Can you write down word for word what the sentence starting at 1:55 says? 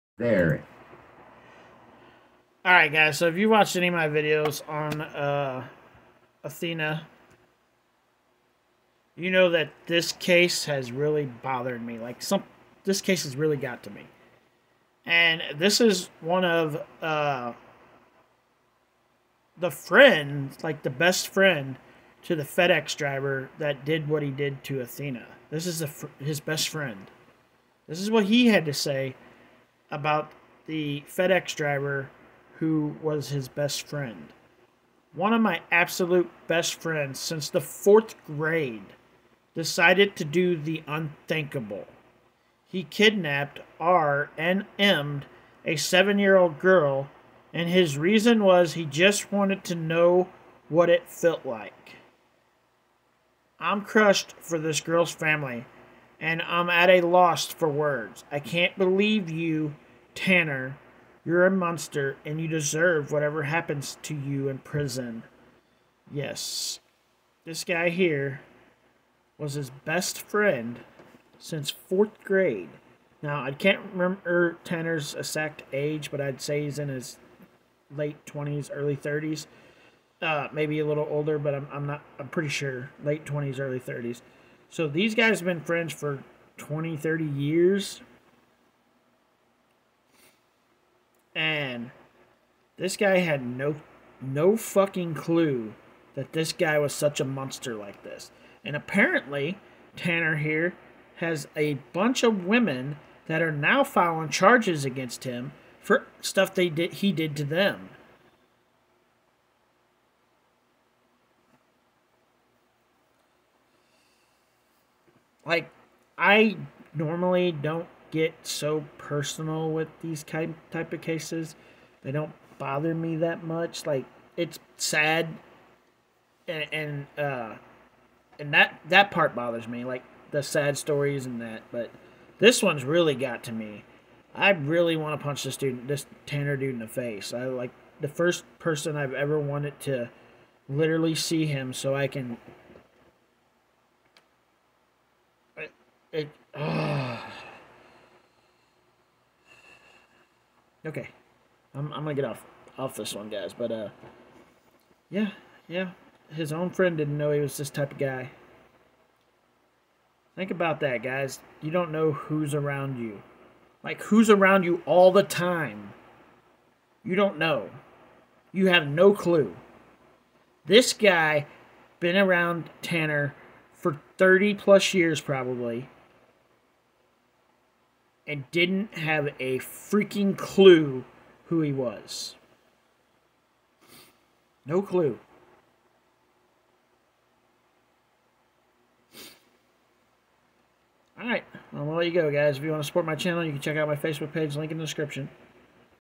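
Like I normally don't get so personal with these type type of cases.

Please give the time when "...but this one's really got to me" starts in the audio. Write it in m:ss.
2:11.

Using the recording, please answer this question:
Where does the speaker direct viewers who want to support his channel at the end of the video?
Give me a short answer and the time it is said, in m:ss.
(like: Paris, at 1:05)
Facebook page, at 3:13.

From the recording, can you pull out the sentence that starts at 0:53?
I'm crushed for this girl's family, and I'm at a loss for words.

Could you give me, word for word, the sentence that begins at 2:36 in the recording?
His own friend didn't know he was this type of guy.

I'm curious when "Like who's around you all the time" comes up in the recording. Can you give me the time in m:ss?
2:43.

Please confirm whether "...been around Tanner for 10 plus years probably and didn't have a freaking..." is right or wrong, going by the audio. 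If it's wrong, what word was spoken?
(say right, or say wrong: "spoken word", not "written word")
wrong: "30", not "10".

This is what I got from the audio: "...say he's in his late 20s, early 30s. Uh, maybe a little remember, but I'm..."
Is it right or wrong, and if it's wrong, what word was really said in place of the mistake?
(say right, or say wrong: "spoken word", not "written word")
wrong: "older", not "remember".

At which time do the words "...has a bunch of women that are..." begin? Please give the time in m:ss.
1:41.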